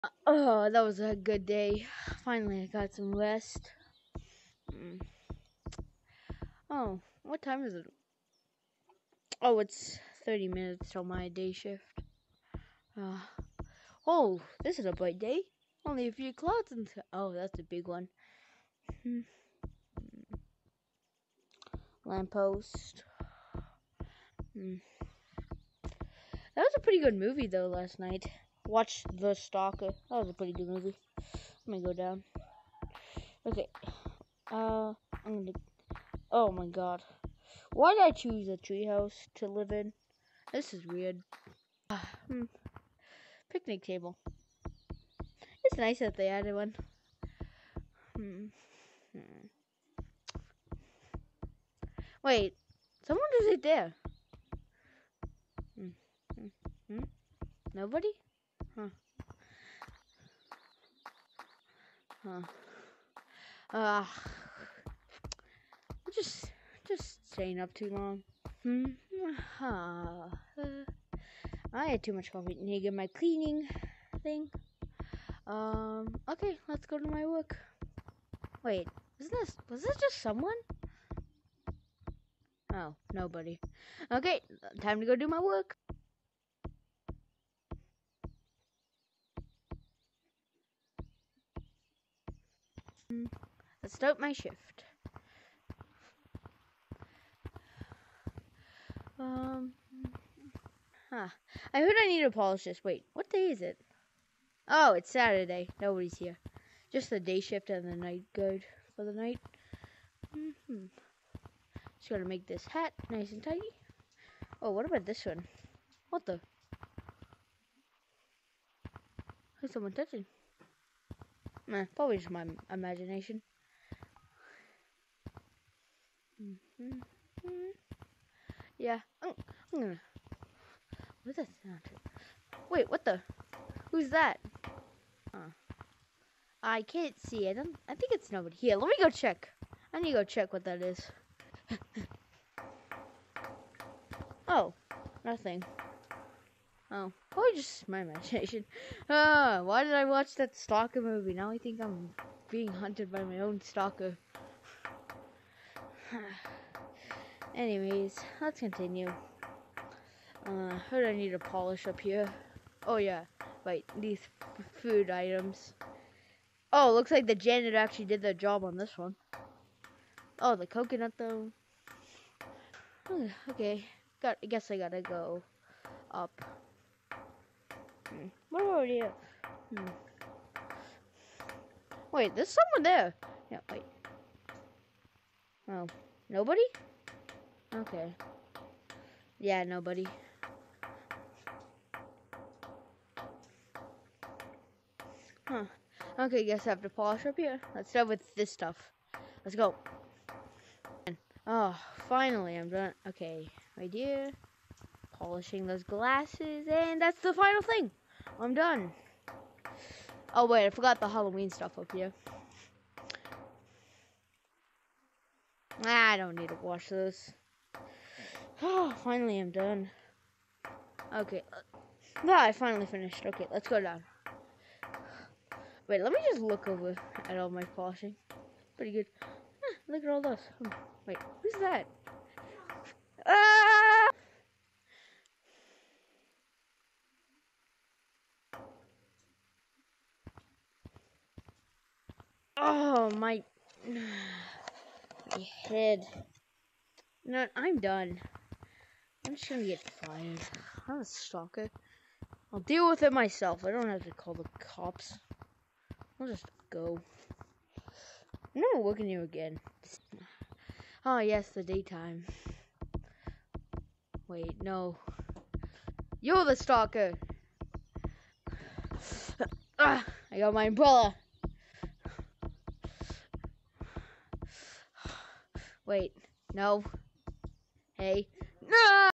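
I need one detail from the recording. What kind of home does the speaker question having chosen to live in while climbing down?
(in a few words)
a treehouse.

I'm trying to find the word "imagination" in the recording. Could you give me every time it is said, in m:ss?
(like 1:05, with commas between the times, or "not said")
2:02, 2:28.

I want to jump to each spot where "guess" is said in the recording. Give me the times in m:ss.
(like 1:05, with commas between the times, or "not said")
2:54, 3:16.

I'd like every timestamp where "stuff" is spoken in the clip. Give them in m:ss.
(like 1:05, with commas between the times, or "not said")
3:18, 3:31.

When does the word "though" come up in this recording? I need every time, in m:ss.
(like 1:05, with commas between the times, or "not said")
0:27, 2:51.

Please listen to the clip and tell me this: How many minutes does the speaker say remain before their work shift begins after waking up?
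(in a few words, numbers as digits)
30.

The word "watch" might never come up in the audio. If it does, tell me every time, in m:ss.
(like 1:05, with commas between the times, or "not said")
0:28, 2:30.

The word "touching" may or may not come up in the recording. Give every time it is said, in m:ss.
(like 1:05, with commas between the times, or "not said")
1:59.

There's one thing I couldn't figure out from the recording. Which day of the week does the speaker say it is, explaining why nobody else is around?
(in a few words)
Saturday.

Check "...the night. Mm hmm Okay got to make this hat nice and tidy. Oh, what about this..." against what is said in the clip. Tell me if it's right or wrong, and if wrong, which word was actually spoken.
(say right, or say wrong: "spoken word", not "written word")
wrong: "Just", not "Okay".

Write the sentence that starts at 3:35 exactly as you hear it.
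I don't need to wash this.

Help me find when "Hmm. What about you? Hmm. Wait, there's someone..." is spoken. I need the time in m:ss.
2:58.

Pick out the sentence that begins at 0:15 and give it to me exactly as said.
Only a few clouds and Oh, that's a big one.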